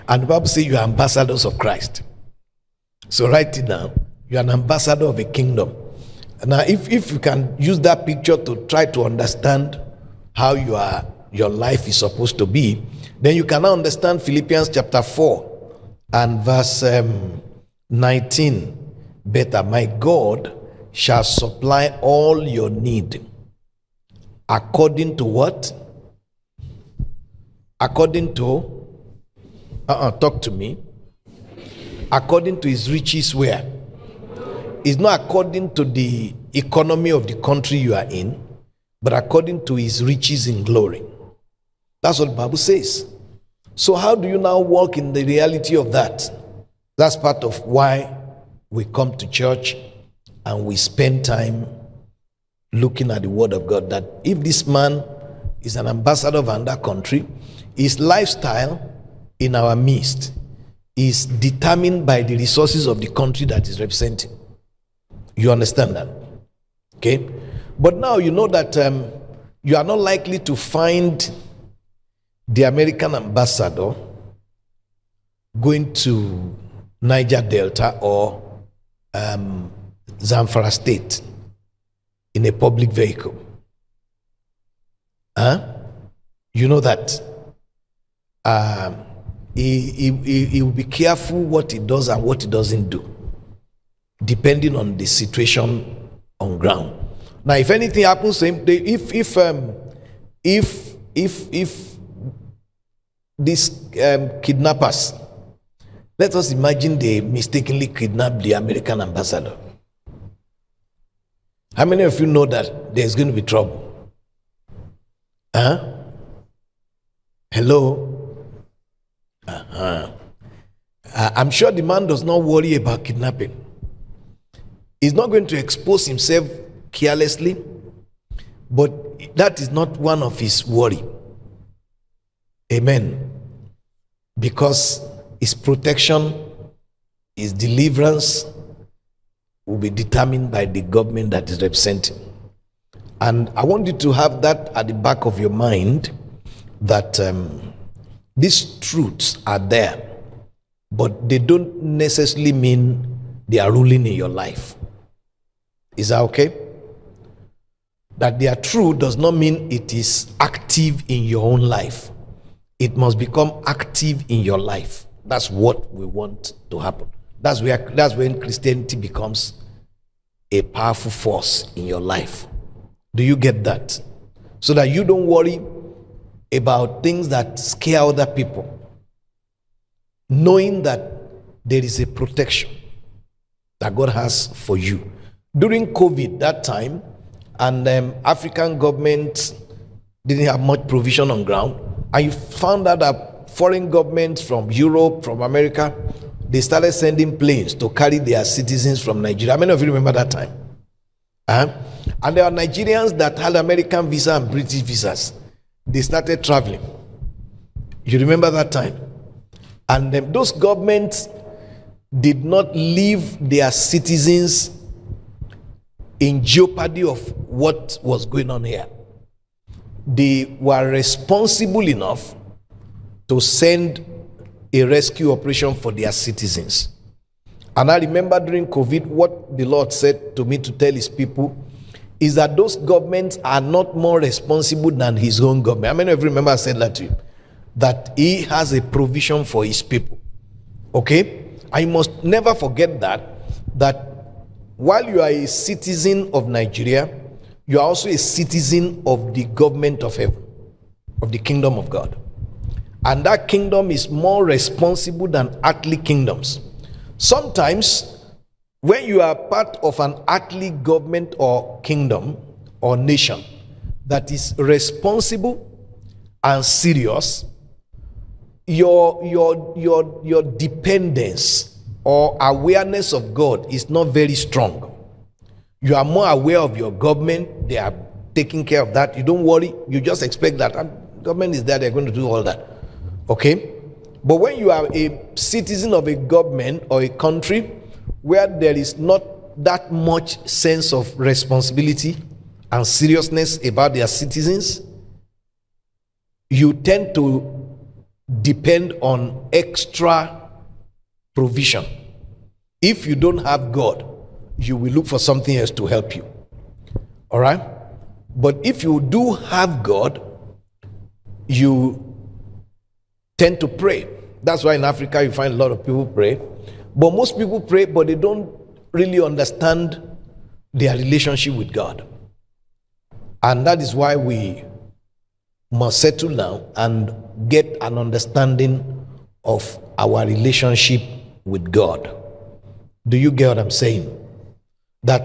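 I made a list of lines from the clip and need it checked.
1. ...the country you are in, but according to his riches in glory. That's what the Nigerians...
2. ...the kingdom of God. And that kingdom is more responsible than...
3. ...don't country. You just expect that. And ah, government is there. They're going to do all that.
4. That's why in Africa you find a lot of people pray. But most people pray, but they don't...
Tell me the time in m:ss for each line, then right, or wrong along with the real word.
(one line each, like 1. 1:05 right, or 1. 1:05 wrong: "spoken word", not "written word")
1. 0:37 wrong: "Bible", not "Nigerians"
2. 4:11 right
3. 4:39 wrong: "worry", not "country"
4. 5:14 right.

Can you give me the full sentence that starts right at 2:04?
He's not going to expose himself carelessly, but that is not one of his worry.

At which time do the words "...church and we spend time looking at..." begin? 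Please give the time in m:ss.
0:49.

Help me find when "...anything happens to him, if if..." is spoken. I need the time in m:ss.
1:37.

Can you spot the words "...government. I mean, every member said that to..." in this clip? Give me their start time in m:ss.
3:55.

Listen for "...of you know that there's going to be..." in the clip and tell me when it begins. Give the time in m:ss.
1:52.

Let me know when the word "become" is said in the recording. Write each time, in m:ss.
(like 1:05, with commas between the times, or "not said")
2:43, 2:48.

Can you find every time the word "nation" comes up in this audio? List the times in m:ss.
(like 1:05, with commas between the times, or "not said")
4:22.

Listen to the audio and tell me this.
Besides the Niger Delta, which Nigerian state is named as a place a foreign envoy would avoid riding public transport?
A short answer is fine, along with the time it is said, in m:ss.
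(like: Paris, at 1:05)
Zamfara State, at 1:20.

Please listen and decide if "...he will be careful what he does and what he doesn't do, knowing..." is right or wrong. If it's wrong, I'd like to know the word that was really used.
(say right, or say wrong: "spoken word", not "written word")
wrong: "depending", not "knowing".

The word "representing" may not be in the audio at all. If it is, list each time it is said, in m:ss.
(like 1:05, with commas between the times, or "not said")
1:03, 2:21.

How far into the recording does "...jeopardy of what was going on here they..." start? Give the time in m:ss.
3:36.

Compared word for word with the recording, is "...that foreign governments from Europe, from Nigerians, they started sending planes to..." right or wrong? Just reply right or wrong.
wrong.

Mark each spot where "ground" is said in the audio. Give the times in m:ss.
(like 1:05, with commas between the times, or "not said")
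1:36, 3:11.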